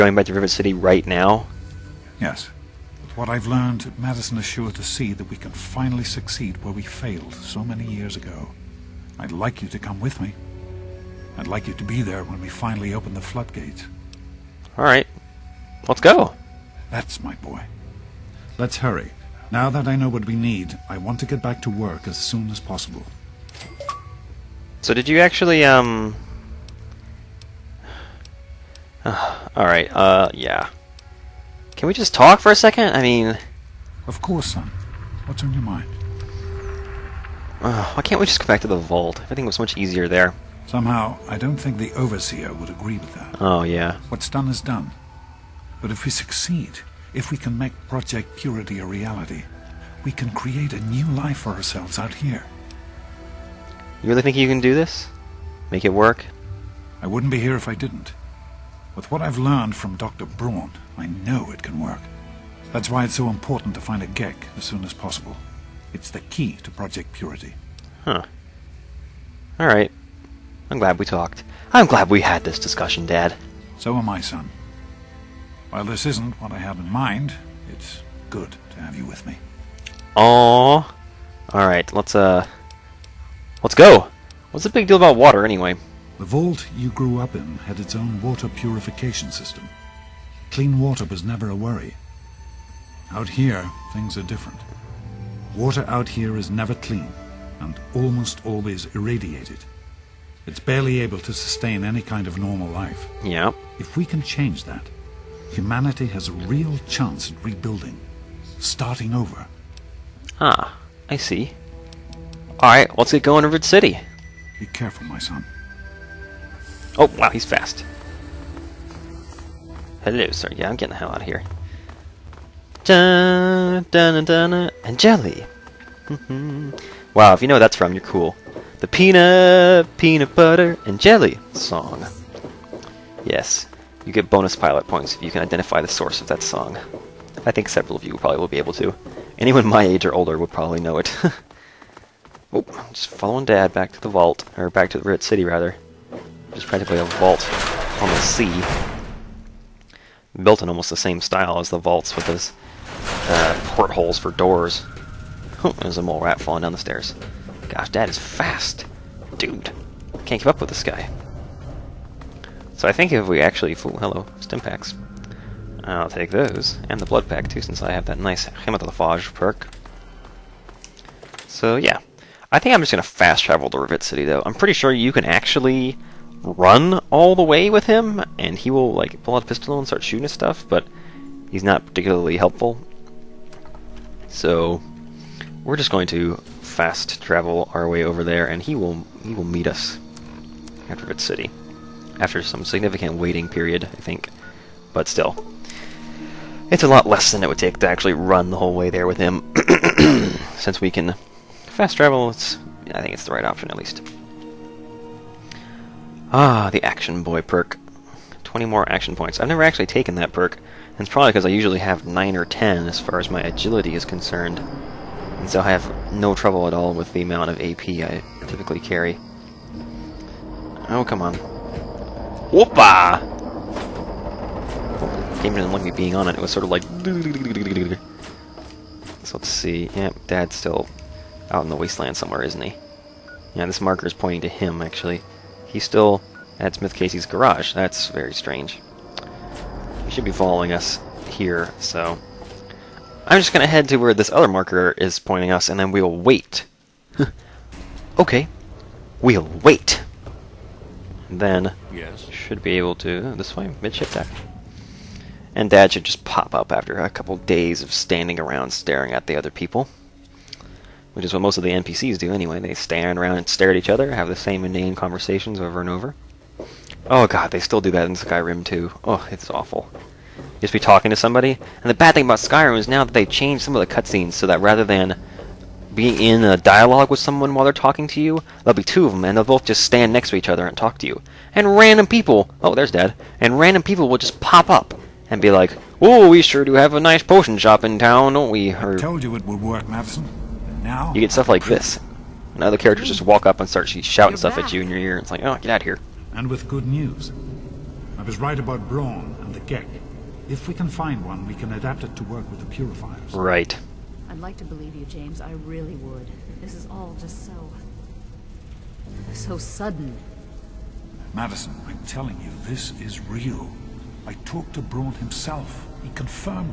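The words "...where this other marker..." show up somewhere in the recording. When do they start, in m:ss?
4:03.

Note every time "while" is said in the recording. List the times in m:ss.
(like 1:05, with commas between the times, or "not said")
1:15, 4:37.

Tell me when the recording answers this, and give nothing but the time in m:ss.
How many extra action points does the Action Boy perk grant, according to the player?
3:28.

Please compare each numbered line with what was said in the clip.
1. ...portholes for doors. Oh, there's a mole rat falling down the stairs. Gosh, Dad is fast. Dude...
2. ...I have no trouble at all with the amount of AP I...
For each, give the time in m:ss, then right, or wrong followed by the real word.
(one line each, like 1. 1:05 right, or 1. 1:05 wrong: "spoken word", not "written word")
1. 2:33 right
2. 3:35 right.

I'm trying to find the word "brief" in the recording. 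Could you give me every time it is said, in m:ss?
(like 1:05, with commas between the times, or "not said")
not said.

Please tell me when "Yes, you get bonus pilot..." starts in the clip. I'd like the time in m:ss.
2:13.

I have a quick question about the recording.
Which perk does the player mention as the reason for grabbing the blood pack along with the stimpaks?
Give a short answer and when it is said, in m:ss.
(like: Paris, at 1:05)
Hematophage, at 2:48.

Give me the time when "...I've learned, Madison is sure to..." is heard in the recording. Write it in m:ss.
0:03.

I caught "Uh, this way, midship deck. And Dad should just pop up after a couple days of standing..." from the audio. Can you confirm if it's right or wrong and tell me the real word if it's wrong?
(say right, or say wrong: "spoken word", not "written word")
right.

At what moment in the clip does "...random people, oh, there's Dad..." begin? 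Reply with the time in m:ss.
4:41.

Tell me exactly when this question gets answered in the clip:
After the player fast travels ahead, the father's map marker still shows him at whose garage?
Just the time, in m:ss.
3:56.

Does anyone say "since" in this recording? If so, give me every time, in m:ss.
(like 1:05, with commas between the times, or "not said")
2:47, 3:20.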